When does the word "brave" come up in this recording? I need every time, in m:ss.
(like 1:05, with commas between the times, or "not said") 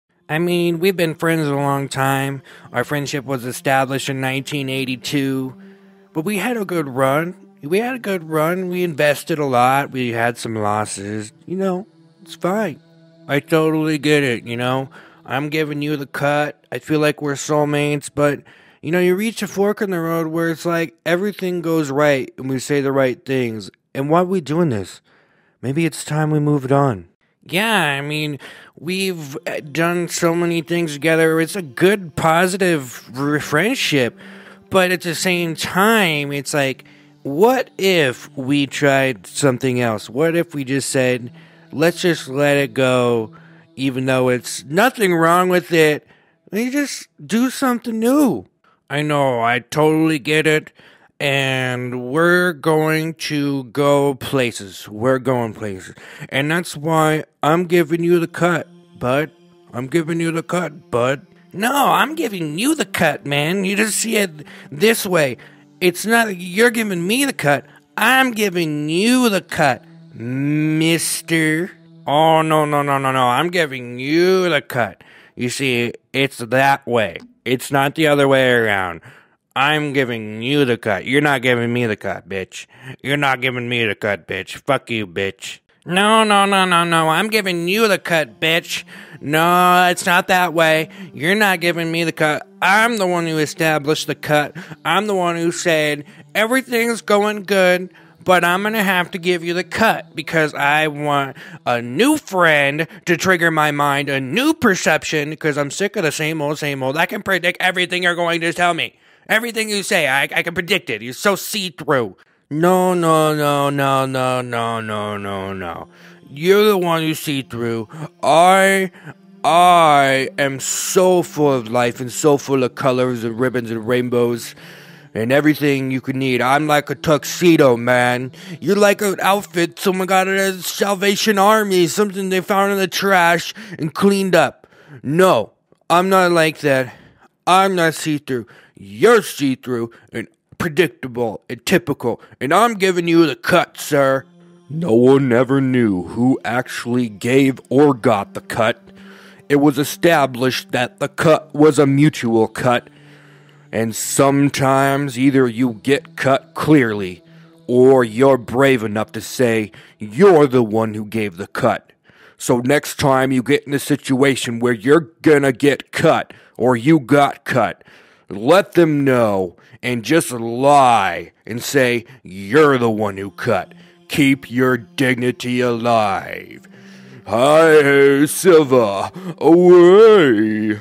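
2:38.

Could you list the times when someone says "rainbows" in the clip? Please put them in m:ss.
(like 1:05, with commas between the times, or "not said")
2:03.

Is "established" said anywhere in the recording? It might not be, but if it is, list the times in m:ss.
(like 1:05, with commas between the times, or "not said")
0:03, 1:33, 2:29.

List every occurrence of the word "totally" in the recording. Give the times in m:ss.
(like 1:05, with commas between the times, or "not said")
0:13, 0:49.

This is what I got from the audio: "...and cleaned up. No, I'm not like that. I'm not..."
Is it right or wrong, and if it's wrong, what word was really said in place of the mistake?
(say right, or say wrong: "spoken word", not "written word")
right.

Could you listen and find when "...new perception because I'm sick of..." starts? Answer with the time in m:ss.
1:44.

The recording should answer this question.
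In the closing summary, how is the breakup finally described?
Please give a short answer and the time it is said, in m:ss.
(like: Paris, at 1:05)
A mutual cut, at 2:31.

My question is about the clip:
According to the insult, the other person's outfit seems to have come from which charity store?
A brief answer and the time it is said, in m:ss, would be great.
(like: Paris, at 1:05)
Salvation Army, at 2:10.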